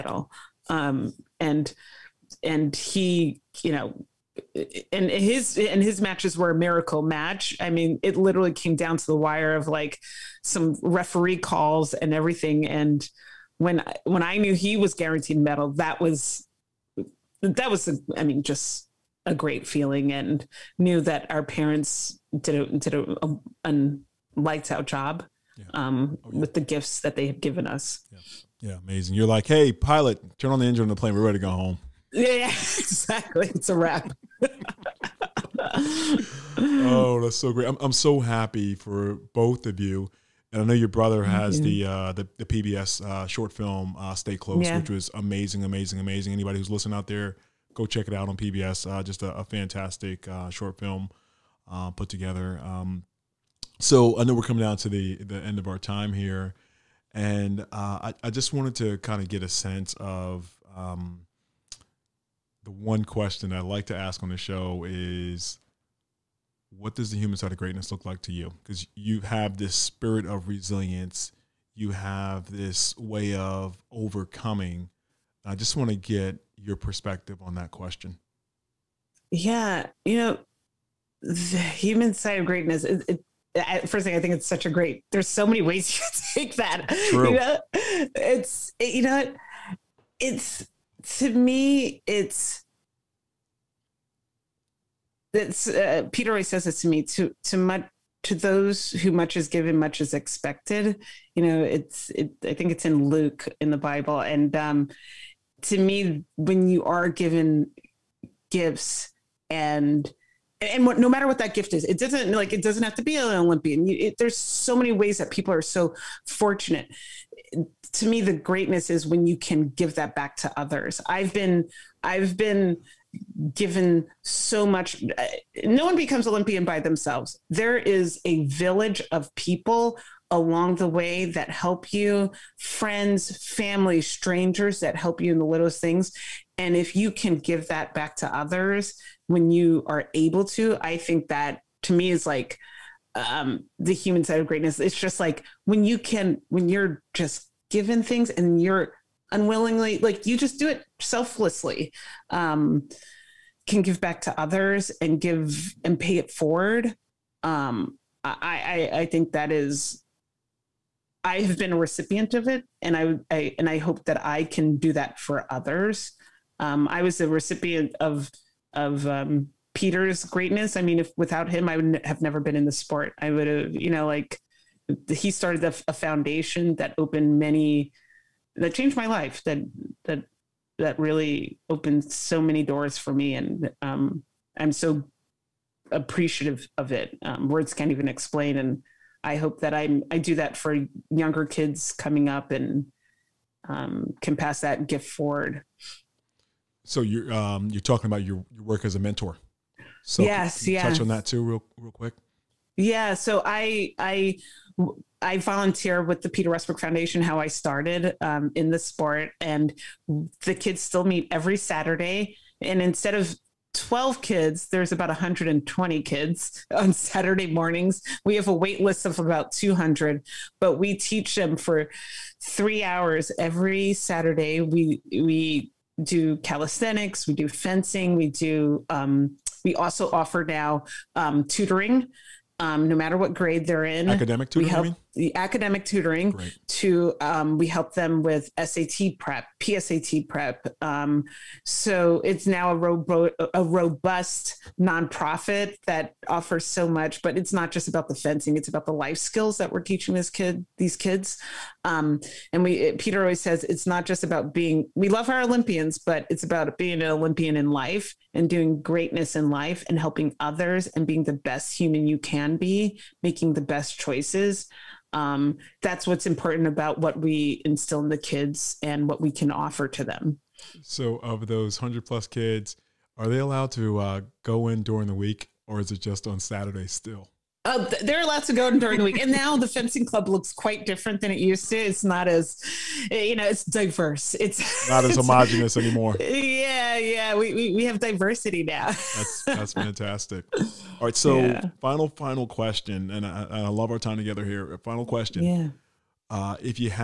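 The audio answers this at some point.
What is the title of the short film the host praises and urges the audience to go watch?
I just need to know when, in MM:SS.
00:44.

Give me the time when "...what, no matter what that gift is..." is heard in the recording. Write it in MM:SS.
01:50.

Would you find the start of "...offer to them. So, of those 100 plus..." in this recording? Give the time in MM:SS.
04:29.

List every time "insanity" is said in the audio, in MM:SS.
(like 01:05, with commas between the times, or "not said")
not said.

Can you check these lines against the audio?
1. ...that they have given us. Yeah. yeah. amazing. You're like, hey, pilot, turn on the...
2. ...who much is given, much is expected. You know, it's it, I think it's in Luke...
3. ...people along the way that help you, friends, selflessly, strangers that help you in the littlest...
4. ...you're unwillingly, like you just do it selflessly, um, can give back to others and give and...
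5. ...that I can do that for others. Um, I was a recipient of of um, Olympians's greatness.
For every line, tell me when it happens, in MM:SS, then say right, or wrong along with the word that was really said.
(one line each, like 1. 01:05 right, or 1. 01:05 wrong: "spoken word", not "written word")
1. 00:26 right
2. 01:38 right
3. 02:09 wrong: "family", not "selflessly"
4. 02:28 right
5. 02:44 wrong: "Peter", not "Olympians".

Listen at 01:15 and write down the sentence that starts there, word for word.
I just want to get your perspective on that question.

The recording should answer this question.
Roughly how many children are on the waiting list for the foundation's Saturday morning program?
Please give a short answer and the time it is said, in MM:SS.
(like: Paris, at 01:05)
200, at 03:39.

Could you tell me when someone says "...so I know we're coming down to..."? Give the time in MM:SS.
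00:53.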